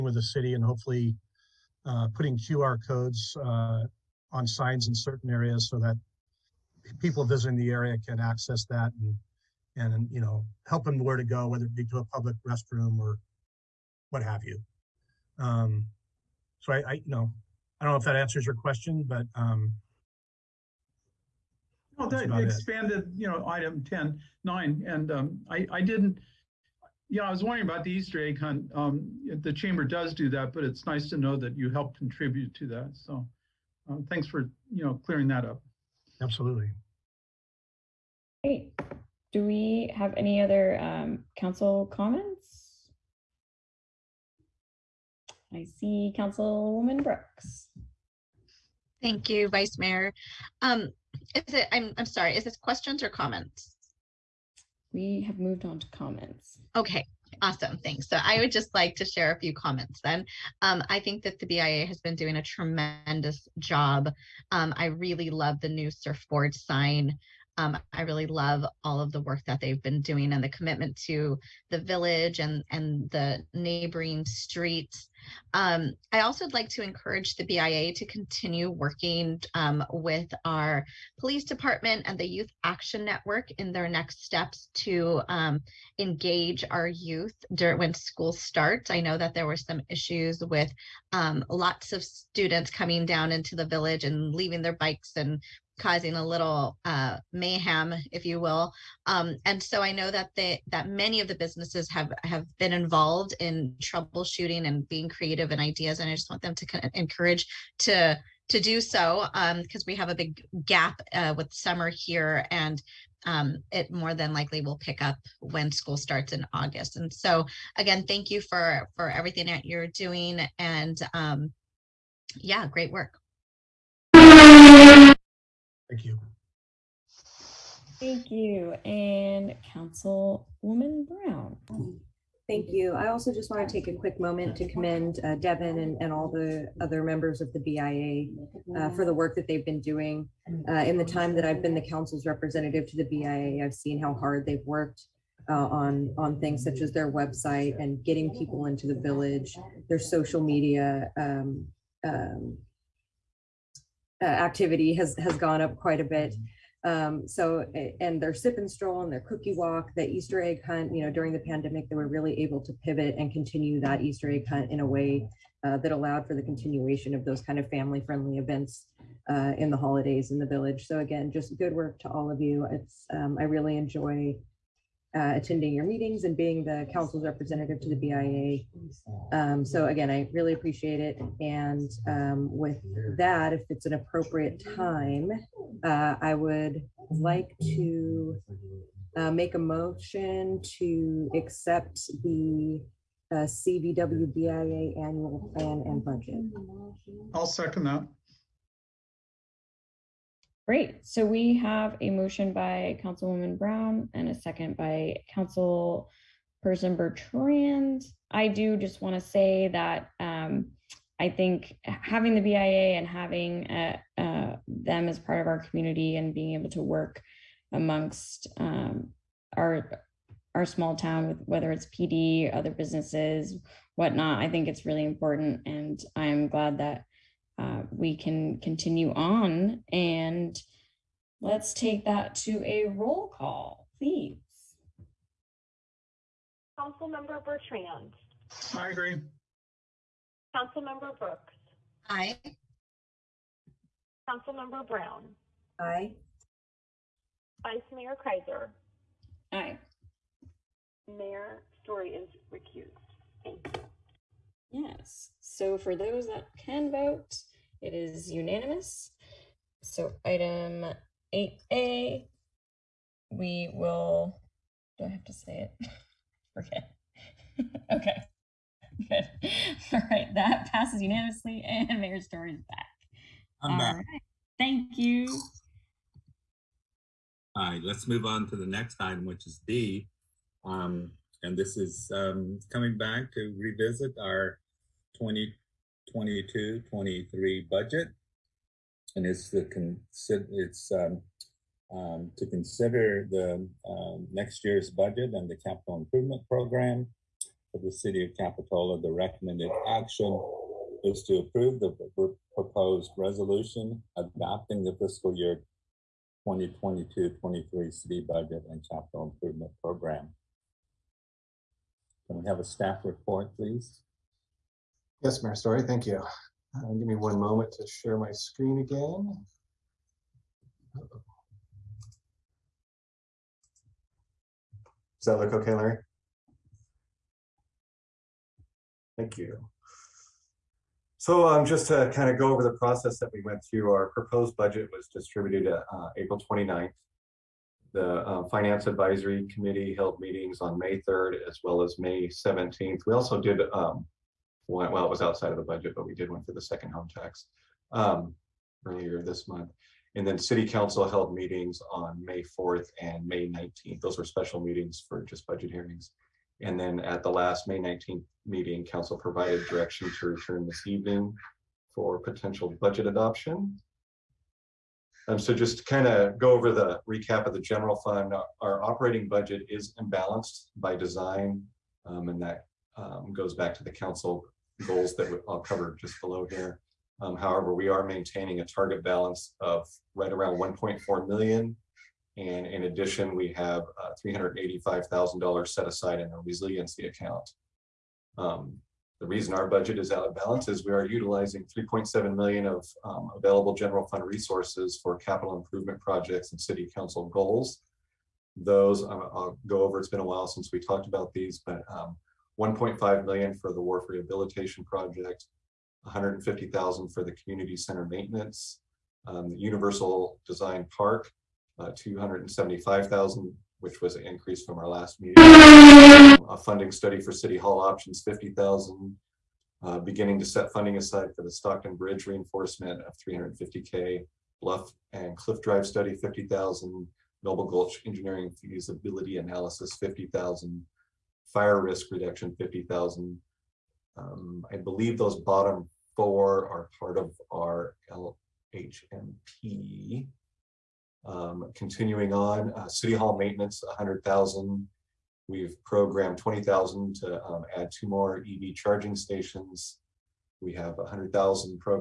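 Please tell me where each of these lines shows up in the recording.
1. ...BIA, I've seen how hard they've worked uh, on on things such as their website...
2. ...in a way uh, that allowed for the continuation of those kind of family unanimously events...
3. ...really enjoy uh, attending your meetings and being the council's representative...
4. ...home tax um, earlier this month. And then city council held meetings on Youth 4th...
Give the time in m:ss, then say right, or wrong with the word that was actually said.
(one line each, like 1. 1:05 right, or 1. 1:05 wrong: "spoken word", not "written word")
1. 2:23 right
2. 2:44 wrong: "friendly", not "unanimously"
3. 2:53 right
4. 5:46 wrong: "May", not "Youth".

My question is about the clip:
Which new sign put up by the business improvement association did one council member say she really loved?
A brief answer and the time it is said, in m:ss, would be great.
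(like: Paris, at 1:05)
surfboard sign, at 1:05.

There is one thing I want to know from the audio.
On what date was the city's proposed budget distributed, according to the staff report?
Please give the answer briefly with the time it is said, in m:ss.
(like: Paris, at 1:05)
April 29th, at 5:36.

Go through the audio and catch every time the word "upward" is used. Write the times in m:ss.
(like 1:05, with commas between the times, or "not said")
not said.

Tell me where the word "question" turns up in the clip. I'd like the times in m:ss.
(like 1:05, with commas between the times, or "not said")
0:18, 0:52.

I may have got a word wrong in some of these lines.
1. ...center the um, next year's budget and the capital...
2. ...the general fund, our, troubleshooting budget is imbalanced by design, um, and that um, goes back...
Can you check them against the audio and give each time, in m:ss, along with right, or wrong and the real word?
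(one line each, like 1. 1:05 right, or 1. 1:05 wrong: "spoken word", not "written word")
1. 4:52 wrong: "consider", not "center"
2. 6:07 wrong: "operating", not "troubleshooting".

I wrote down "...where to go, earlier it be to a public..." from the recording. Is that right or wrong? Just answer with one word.
wrong.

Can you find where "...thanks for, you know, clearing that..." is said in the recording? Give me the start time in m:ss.
0:34.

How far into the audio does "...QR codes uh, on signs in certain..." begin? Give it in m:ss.
0:02.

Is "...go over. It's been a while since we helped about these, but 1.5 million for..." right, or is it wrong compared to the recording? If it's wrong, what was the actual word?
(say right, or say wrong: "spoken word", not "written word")
wrong: "talked", not "helped".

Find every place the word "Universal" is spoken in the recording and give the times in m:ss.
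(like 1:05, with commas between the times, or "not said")
6:49.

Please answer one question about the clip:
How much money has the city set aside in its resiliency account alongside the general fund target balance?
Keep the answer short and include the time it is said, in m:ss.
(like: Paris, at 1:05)
$385,000, at 6:24.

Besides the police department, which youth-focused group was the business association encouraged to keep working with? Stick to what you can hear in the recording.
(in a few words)
Youth Action Network.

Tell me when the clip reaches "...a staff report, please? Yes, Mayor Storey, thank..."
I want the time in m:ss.
5:12.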